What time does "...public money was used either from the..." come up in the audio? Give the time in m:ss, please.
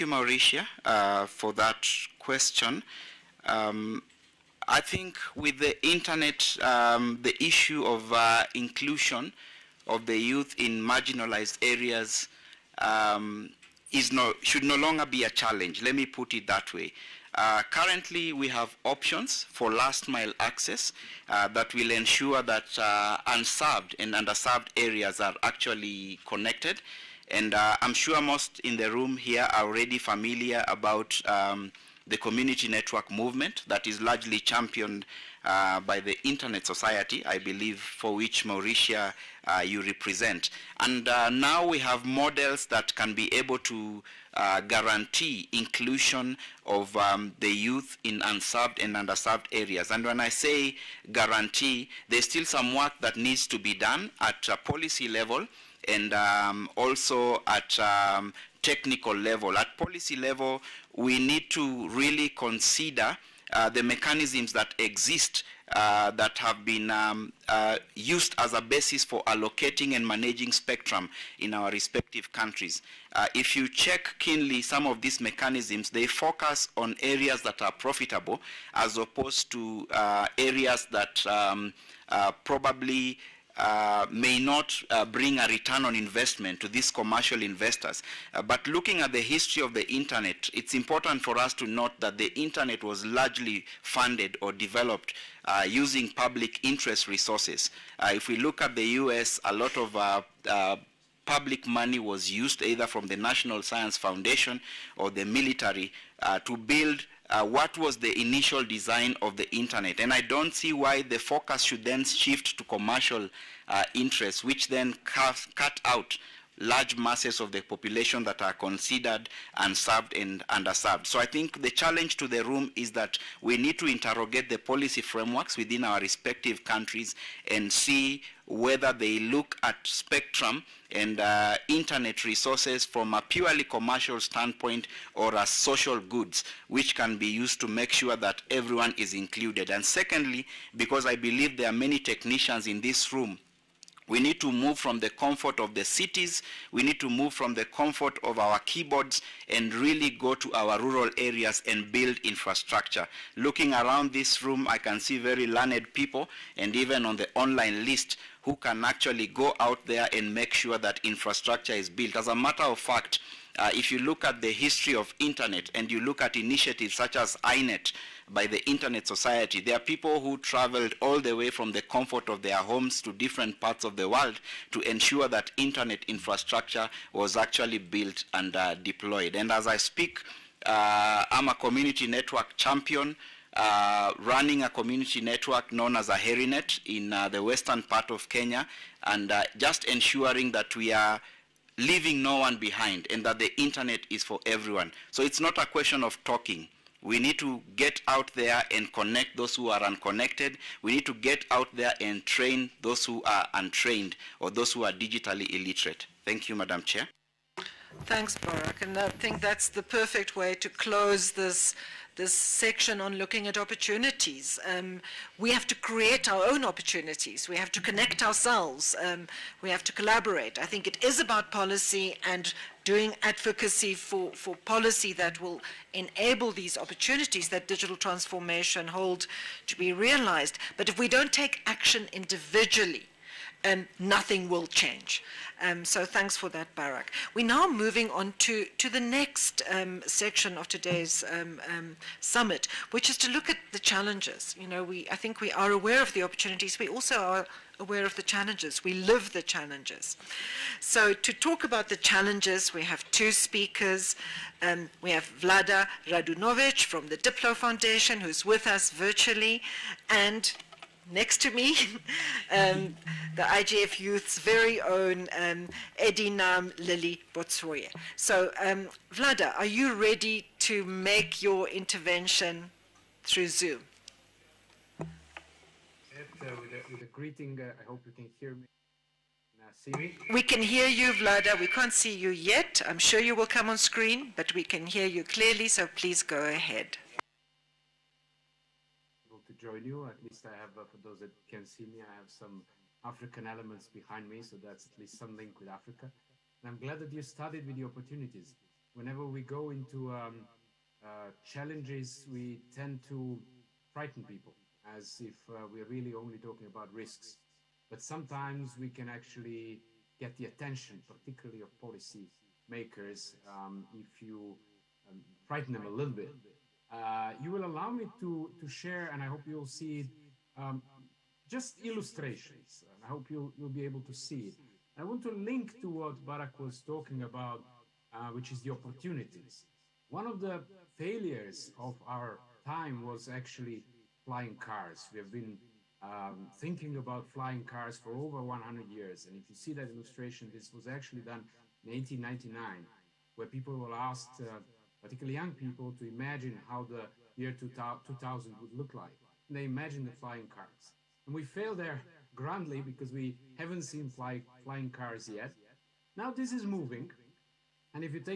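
1:41.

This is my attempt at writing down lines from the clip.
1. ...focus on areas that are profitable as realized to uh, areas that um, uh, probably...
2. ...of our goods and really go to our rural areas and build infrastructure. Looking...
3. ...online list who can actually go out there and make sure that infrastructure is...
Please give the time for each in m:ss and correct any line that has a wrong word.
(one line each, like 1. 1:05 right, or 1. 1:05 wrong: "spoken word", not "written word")
1. 1:16 wrong: "opposed", not "realized"
2. 2:28 wrong: "keyboards", not "goods"
3. 2:37 right.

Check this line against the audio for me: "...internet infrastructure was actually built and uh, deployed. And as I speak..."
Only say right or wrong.
right.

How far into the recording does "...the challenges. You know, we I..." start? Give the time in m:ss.
4:03.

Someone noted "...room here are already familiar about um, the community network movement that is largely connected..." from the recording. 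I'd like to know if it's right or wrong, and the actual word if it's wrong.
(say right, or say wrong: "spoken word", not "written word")
wrong: "championed", not "connected".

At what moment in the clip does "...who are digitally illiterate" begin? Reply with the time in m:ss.
3:24.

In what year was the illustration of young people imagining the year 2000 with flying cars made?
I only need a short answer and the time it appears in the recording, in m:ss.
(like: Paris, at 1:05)
1899, at 5:41.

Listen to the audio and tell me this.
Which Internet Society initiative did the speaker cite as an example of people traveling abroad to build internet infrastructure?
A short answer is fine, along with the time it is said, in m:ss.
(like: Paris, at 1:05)
INET, at 2:47.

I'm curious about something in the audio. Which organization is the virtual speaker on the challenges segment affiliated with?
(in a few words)
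Diplo Foundation.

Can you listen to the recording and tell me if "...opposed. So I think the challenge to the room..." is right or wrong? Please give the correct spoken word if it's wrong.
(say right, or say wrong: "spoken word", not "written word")
wrong: "underserved", not "opposed".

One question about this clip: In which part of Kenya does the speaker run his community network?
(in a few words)
western part of Kenya.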